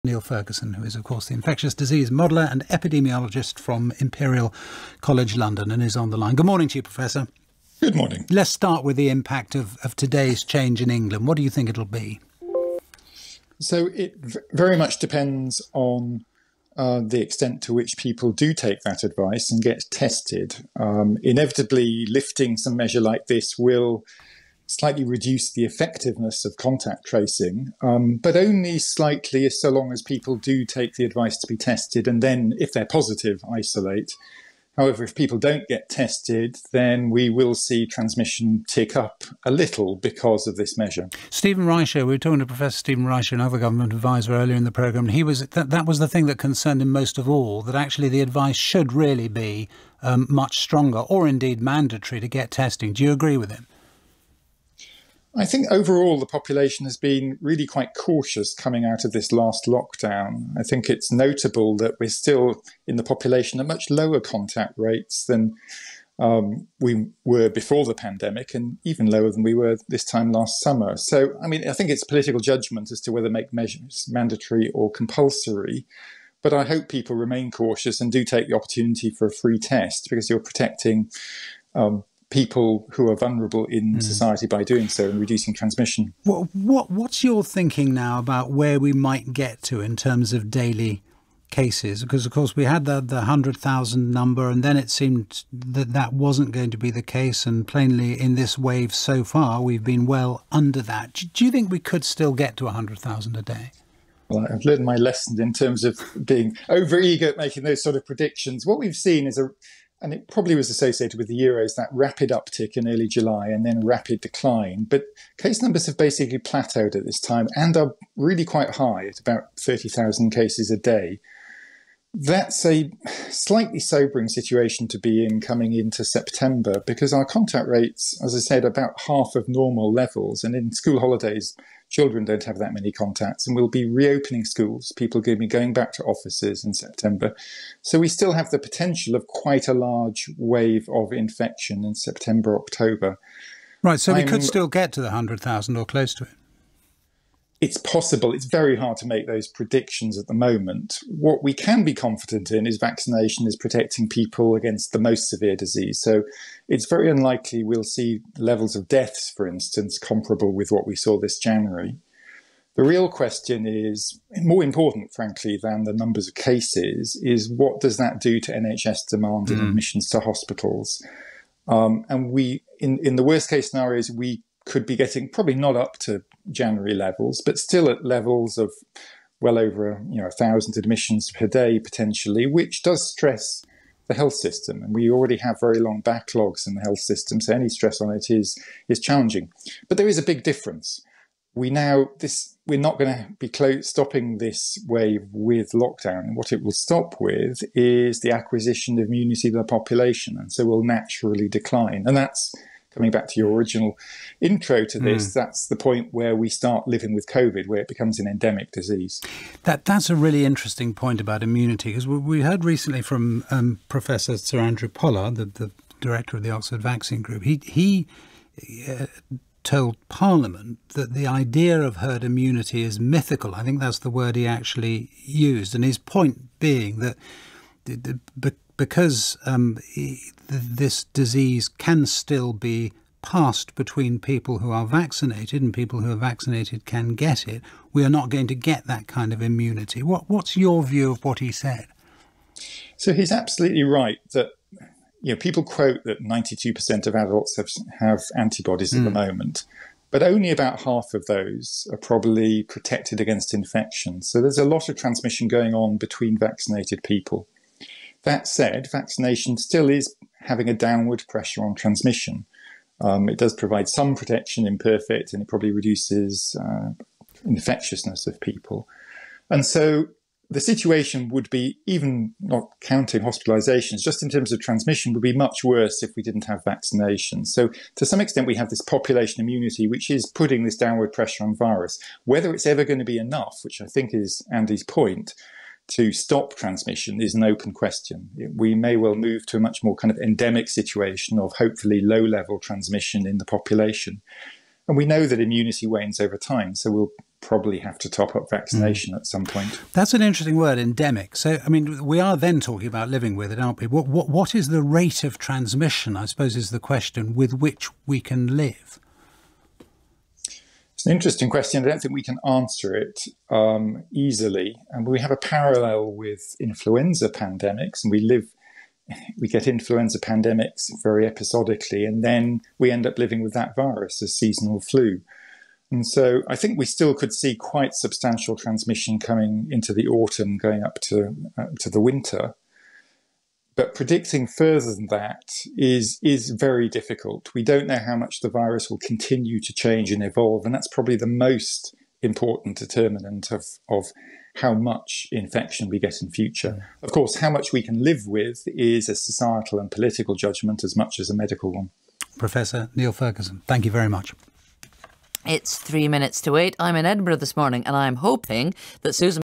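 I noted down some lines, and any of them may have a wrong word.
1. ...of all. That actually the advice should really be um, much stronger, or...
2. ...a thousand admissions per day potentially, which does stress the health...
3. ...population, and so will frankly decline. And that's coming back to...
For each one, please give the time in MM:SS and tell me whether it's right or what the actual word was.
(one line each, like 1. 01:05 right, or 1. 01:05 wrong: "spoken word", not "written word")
1. 00:47 right
2. 03:00 right
3. 03:19 wrong: "naturally", not "frankly".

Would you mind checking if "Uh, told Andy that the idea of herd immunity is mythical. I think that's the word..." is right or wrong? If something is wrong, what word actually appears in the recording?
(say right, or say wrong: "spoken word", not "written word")
wrong: "Parliament", not "Andy".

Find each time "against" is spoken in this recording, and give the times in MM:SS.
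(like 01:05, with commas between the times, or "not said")
02:34, 04:13.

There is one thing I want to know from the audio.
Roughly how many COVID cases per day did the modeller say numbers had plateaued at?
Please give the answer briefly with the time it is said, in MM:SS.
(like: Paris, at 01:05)
30,000, at 01:59.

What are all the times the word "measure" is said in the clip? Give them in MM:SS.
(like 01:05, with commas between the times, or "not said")
00:22, 00:40, 01:13.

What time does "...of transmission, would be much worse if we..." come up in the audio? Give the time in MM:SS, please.
04:34.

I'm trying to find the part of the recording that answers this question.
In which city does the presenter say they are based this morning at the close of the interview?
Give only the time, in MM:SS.
05:57.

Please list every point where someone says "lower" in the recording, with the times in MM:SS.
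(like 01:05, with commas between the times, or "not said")
01:03, 01:09.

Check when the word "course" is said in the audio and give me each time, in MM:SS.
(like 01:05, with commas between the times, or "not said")
00:01, 01:32, 05:47.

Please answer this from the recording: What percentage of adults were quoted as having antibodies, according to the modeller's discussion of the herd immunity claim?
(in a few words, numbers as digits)
92%.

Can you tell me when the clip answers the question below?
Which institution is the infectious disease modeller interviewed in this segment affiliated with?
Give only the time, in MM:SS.
00:03.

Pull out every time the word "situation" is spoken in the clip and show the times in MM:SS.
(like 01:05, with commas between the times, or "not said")
02:04, 04:30, 04:50.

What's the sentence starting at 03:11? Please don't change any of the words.
We now this we're not going to be clo- stopping this wave with lockdown.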